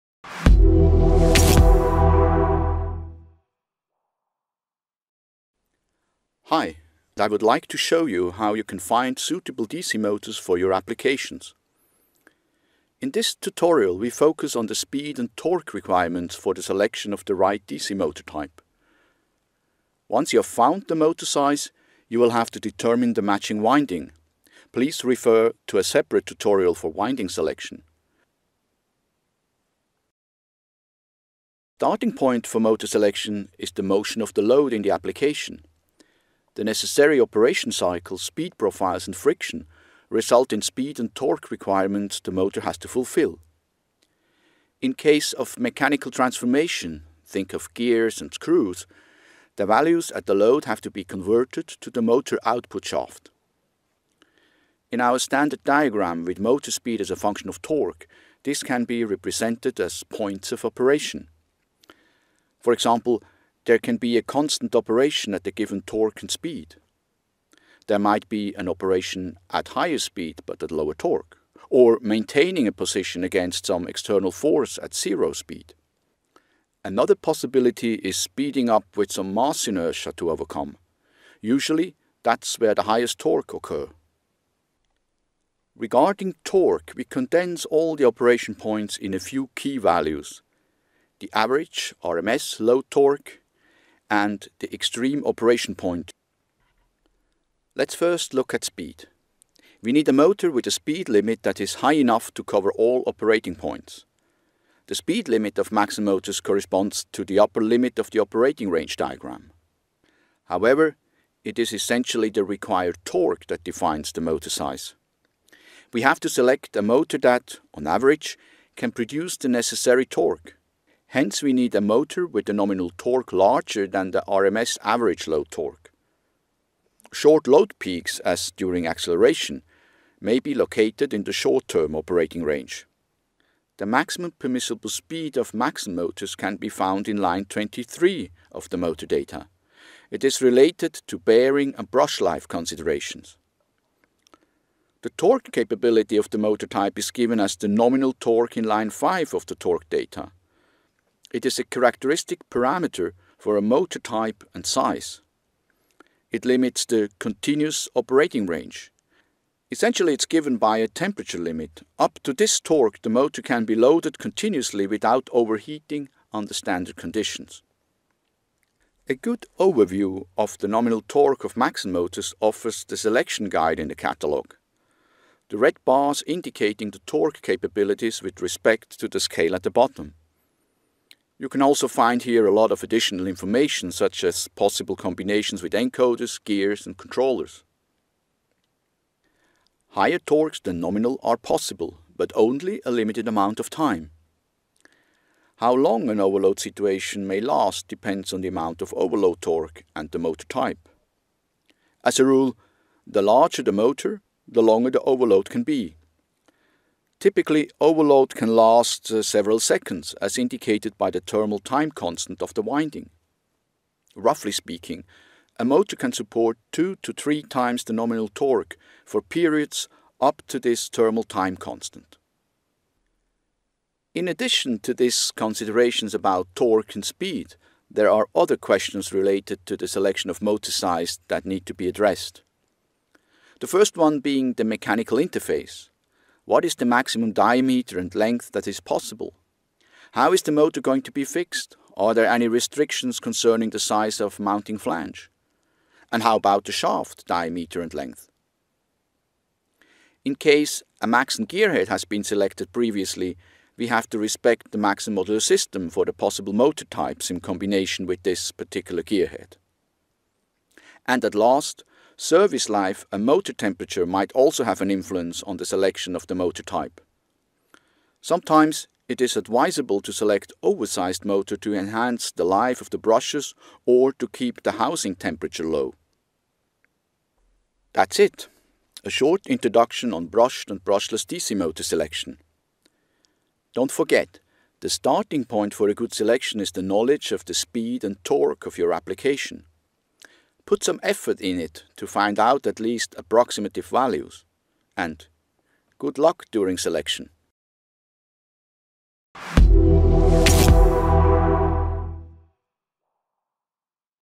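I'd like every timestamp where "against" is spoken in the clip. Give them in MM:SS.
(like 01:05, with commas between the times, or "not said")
01:13.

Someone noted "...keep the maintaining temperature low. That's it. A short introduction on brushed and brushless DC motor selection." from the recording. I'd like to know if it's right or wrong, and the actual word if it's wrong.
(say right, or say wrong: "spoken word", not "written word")
wrong: "housing", not "maintaining".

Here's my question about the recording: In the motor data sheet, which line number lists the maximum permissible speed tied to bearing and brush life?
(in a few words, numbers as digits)
23.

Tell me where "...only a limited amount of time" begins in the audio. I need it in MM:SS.
03:12.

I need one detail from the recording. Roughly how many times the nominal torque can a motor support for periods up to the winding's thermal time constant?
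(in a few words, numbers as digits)
2 to 3.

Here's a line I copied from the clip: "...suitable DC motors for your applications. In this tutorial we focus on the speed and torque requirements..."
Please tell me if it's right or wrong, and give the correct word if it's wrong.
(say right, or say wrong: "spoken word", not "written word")
right.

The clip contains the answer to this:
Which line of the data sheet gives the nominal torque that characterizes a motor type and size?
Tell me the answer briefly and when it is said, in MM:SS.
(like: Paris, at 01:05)
5, at 02:28.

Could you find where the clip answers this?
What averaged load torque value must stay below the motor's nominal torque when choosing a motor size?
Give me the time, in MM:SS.
01:32.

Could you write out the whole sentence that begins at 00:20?
Once you have found the motor size, you will have to determine the matching winding.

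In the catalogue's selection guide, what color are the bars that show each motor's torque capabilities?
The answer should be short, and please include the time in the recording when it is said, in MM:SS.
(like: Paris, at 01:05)
Red, at 02:55.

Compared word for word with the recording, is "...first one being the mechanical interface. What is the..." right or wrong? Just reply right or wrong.
right.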